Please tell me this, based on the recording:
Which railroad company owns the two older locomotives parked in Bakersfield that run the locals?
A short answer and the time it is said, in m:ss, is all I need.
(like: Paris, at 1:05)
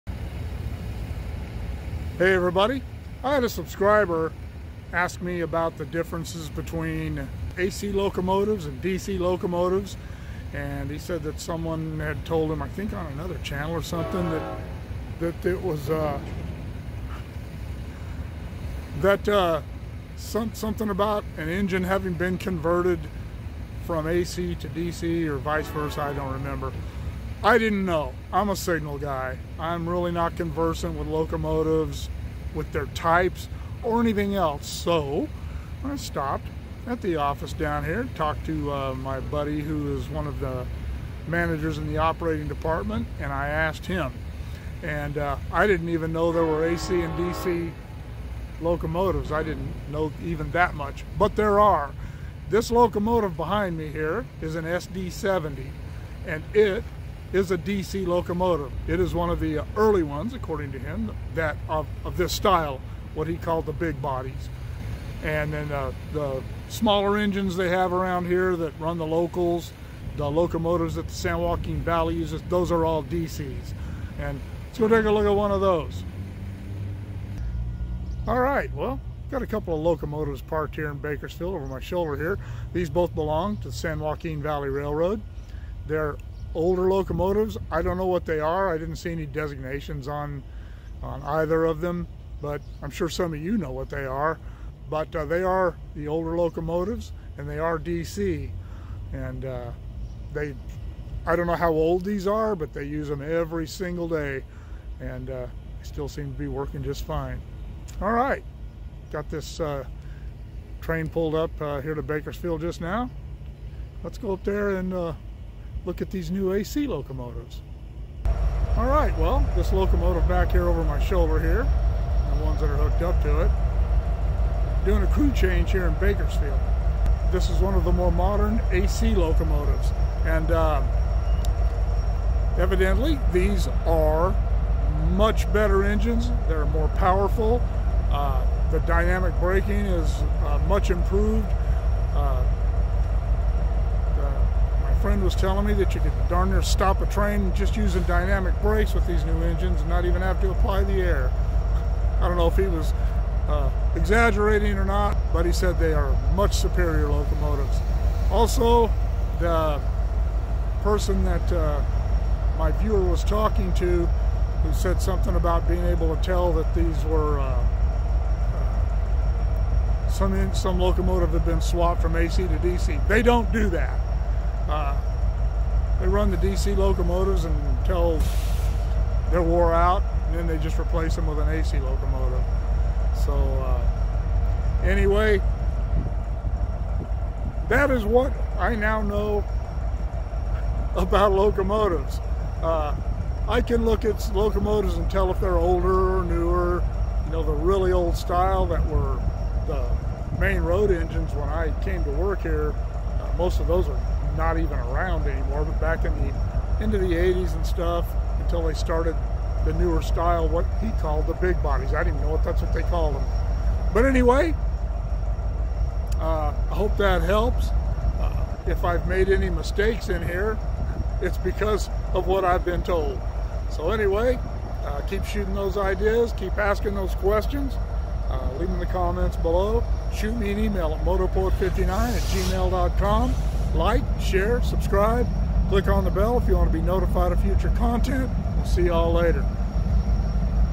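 San Joaquin Valley Railroad, at 1:23.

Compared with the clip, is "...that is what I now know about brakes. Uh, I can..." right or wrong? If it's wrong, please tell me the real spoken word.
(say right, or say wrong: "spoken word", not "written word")
wrong: "locomotives", not "brakes".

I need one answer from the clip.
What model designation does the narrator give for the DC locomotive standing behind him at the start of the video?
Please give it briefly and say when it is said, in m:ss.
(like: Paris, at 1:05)
SD70, at 0:54.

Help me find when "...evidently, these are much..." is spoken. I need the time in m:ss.
2:12.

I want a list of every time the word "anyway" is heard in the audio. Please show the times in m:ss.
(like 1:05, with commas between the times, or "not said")
3:04, 3:34, 3:43.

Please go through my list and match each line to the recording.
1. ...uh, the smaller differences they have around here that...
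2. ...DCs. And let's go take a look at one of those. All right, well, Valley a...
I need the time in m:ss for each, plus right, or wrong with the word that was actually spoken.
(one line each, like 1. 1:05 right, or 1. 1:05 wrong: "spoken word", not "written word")
1. 1:05 wrong: "engines", not "differences"
2. 1:13 wrong: "Got", not "Valley".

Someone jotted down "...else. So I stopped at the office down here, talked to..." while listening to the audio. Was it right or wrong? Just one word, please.
right.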